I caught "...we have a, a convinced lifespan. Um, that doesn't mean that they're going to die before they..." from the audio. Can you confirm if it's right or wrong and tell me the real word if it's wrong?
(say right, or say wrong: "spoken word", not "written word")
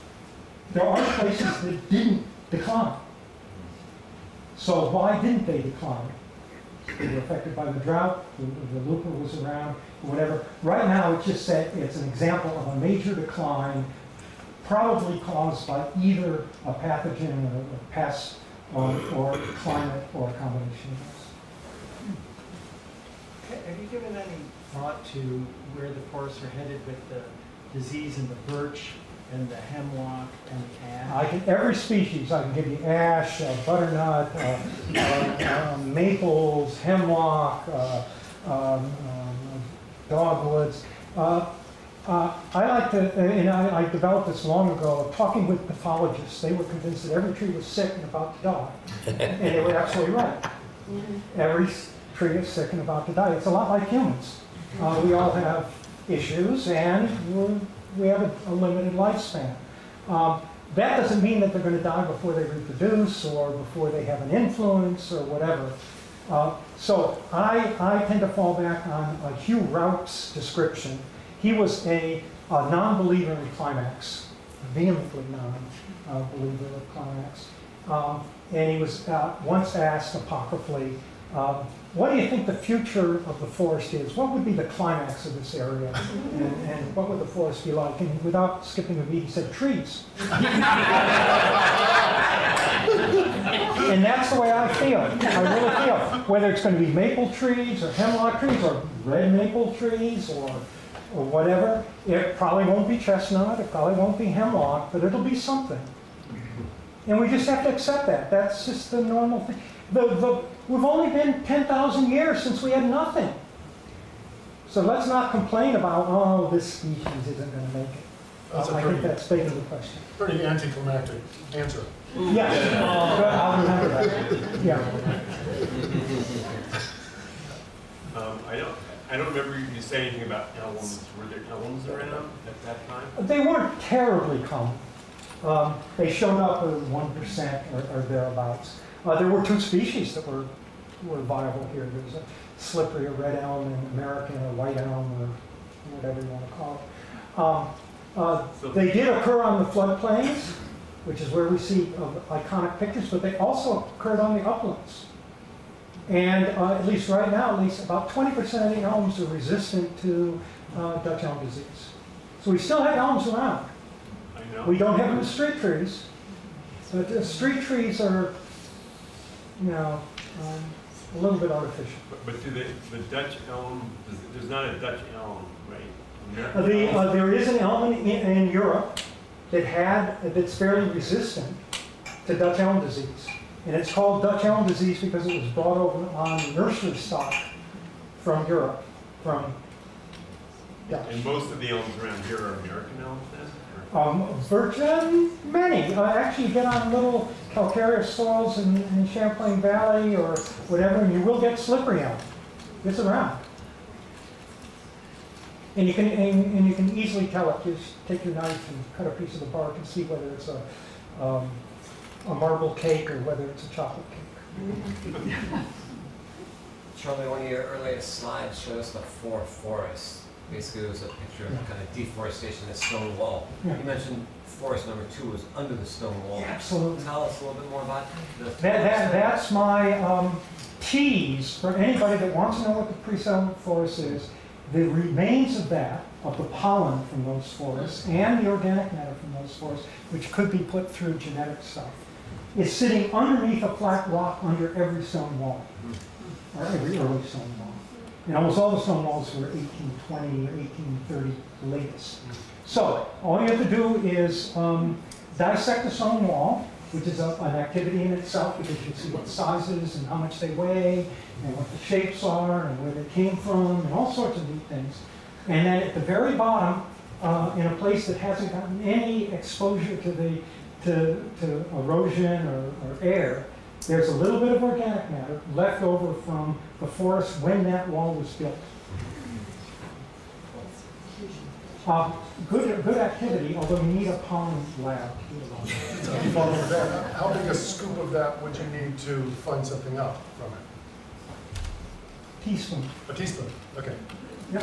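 wrong: "limited", not "convinced".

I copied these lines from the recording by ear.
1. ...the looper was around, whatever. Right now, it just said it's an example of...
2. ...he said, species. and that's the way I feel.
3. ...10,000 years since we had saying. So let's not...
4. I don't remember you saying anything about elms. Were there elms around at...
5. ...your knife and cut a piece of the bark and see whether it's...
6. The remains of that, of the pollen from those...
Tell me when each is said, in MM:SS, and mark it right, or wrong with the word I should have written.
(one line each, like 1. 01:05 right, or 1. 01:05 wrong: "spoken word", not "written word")
1. 00:08 right
2. 01:29 wrong: "trees", not "species"
3. 01:51 wrong: "nothing", not "saying"
4. 02:09 right
5. 03:28 right
6. 03:54 right.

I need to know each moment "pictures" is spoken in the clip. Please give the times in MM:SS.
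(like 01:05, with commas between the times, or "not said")
02:32, 03:41.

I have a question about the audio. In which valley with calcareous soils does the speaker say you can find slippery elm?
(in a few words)
Champlain Valley.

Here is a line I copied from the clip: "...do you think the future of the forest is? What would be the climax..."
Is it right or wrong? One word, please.
right.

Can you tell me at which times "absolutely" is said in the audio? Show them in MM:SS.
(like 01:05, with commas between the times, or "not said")
00:49, 03:46.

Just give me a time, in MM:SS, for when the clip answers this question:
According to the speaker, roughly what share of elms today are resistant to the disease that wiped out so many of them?
02:38.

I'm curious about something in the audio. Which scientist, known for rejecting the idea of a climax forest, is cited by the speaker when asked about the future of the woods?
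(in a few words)
Hugh Raup.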